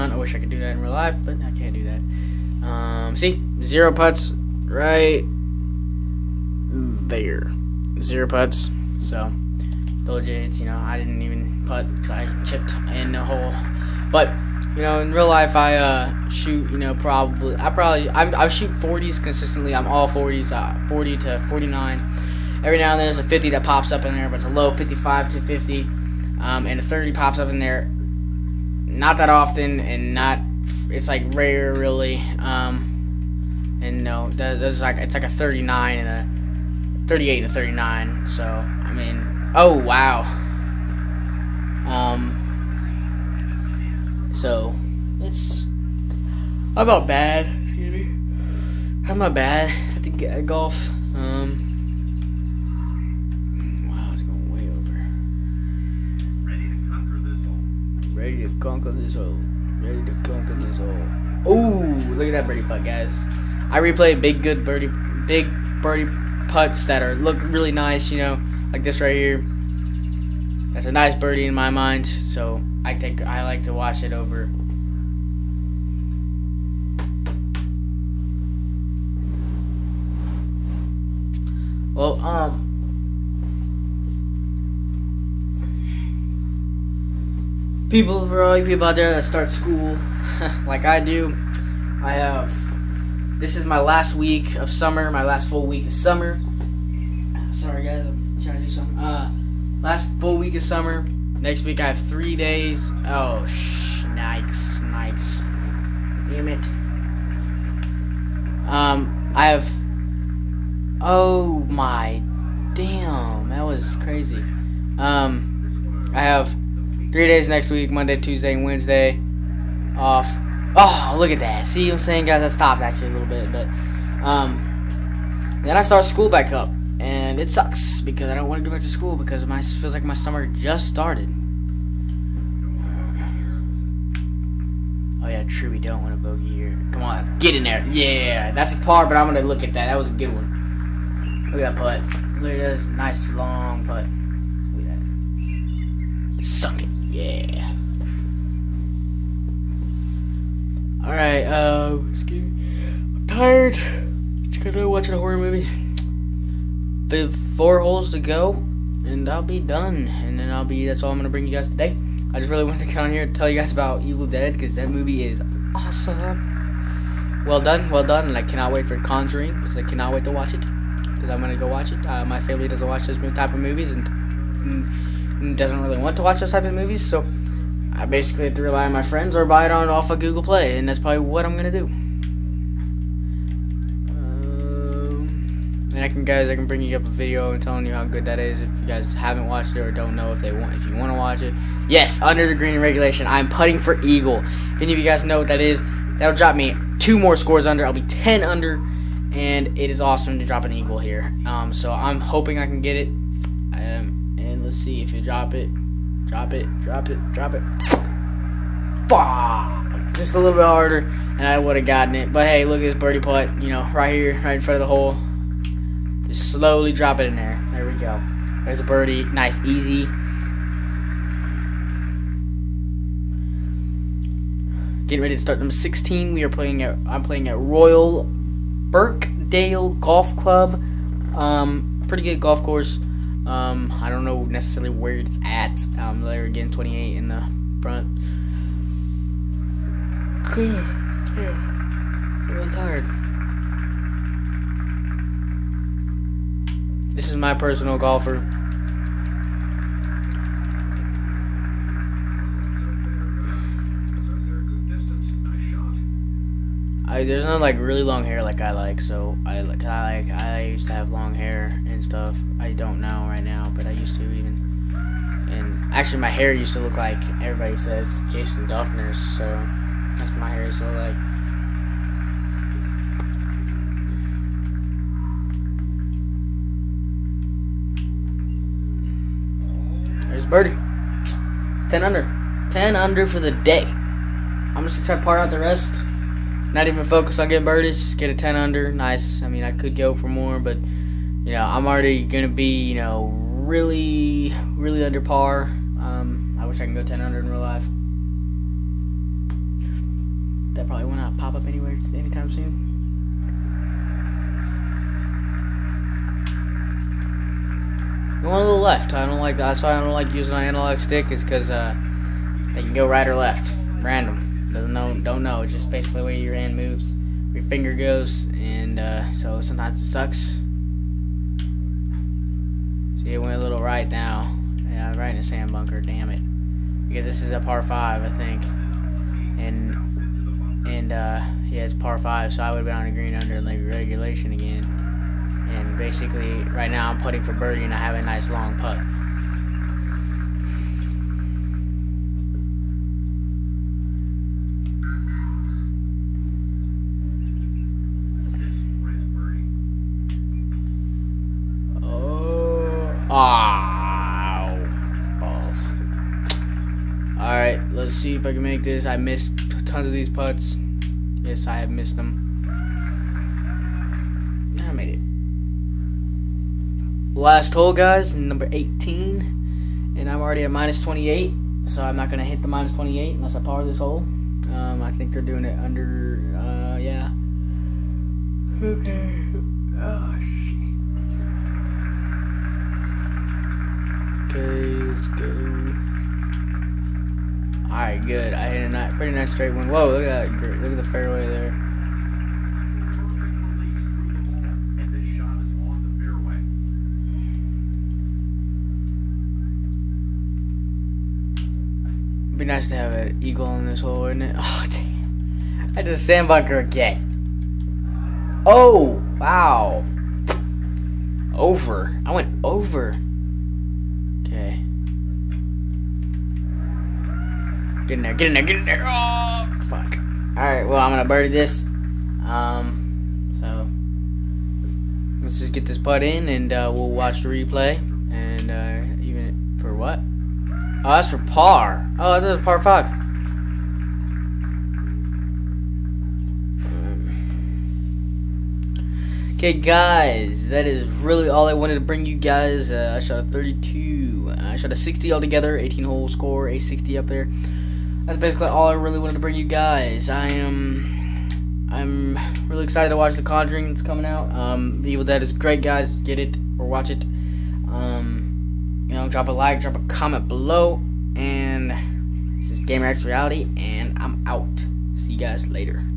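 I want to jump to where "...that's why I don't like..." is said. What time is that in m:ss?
5:09.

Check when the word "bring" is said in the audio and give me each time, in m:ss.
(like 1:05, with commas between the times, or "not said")
2:41, 3:06, 7:22, 7:29.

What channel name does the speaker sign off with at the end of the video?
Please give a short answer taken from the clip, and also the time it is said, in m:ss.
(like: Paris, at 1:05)
GamerX Reality, at 7:42.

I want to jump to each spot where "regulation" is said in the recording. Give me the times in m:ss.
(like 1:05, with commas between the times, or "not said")
3:12, 5:33.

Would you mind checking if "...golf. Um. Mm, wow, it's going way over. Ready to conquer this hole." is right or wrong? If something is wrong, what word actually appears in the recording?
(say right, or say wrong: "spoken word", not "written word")
right.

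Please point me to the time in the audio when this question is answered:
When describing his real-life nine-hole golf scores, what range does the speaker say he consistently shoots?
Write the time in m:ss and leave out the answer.
0:20.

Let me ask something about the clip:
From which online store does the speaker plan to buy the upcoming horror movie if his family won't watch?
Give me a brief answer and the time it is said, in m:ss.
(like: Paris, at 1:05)
Google Play, at 3:00.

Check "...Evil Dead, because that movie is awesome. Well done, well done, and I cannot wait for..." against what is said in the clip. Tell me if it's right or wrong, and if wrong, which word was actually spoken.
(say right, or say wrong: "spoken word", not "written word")
right.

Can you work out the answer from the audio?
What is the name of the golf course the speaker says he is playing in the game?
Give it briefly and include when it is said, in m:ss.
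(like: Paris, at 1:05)
Royal Birkdale Golf Club, at 3:47.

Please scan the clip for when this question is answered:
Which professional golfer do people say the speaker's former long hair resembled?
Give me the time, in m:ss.
4:28.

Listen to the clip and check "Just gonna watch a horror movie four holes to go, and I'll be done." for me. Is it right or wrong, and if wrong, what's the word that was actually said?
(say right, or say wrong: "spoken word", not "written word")
right.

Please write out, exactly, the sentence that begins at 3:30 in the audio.
Just a little bit harder, and I would have gotten it.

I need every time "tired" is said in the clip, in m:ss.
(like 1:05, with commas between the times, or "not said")
2:33, 4:02.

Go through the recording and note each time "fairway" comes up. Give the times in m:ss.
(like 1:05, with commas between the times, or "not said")
6:31.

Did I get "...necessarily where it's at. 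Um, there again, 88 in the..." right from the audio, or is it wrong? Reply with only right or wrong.
wrong.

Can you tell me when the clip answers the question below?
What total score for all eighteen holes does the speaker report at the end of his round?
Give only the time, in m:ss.
7:24.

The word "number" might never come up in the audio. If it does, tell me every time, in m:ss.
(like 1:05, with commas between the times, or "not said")
3:45, 6:08.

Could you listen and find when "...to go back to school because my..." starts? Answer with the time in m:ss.
2:08.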